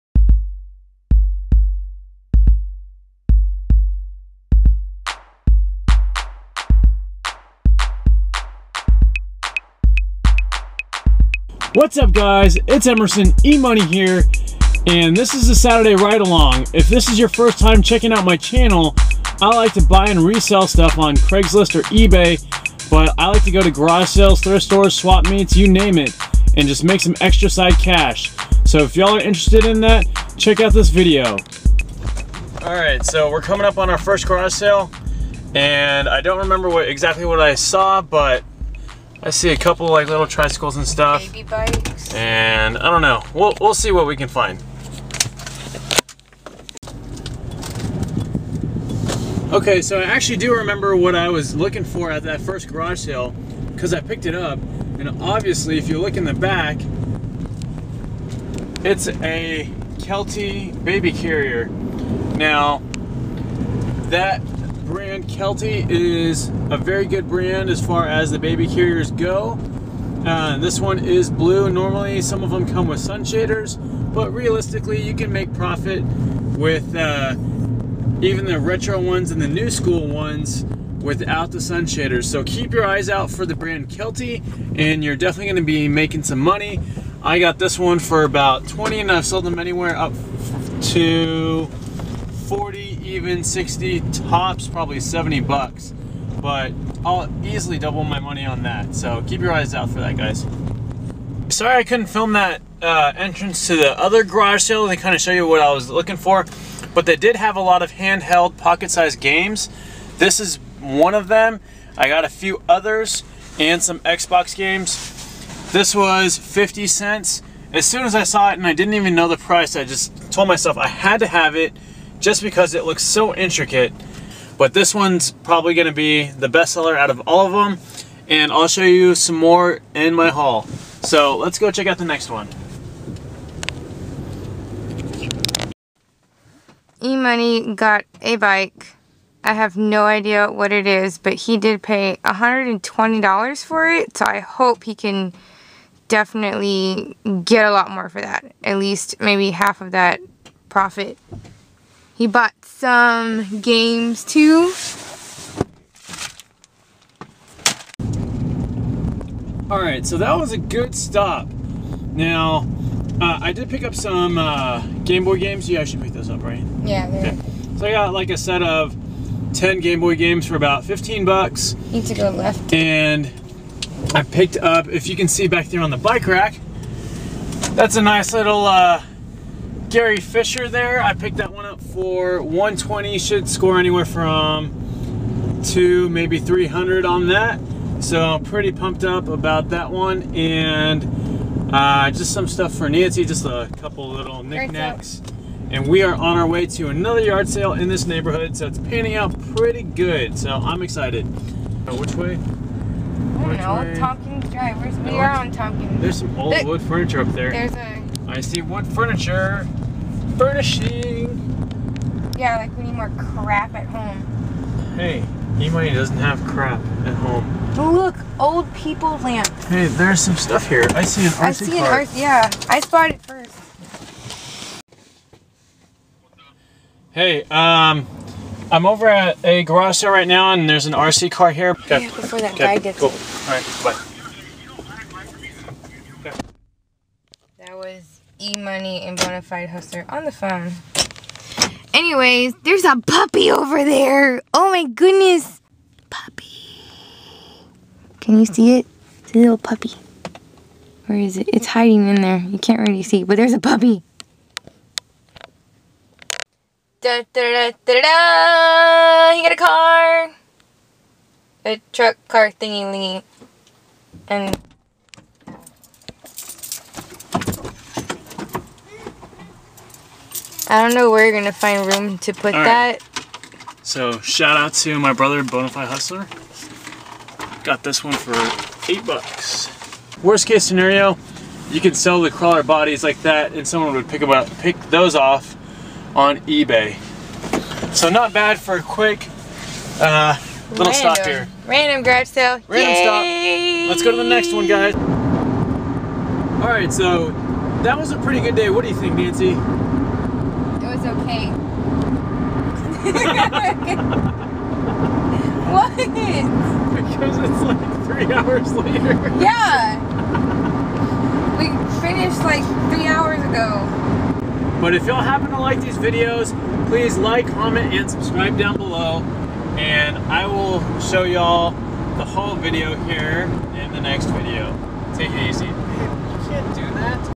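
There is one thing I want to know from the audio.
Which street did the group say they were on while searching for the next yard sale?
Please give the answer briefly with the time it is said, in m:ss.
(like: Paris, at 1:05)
Tompkins Drive, at 3:23.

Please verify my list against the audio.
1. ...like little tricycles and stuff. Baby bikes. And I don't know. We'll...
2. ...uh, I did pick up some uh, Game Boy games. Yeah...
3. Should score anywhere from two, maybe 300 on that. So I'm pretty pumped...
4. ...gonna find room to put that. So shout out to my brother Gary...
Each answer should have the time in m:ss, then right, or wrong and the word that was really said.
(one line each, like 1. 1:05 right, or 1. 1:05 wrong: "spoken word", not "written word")
1. 0:39 right
2. 2:43 right
3. 3:03 right
4. 4:31 wrong: "Bonafide", not "Gary".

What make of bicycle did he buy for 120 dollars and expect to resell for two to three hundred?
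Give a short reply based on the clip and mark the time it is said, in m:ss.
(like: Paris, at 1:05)
Gary Fisher, at 2:59.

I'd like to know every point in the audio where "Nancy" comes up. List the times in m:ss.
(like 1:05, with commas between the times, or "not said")
3:12, 4:59.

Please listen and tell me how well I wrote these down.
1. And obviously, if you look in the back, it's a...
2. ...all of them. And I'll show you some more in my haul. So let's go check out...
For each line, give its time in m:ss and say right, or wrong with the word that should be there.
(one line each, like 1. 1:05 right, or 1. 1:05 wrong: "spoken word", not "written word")
1. 0:54 right
2. 2:07 right.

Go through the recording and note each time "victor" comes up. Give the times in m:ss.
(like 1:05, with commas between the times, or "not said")
not said.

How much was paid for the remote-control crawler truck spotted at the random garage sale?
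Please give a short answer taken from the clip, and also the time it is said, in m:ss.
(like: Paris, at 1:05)
$8, at 4:38.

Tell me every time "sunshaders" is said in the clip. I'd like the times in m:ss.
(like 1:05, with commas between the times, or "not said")
1:12, 1:21.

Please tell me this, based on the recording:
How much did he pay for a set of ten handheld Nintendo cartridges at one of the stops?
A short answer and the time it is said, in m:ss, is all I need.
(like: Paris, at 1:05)
$15, at 2:50.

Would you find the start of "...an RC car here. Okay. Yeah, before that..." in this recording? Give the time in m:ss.
3:50.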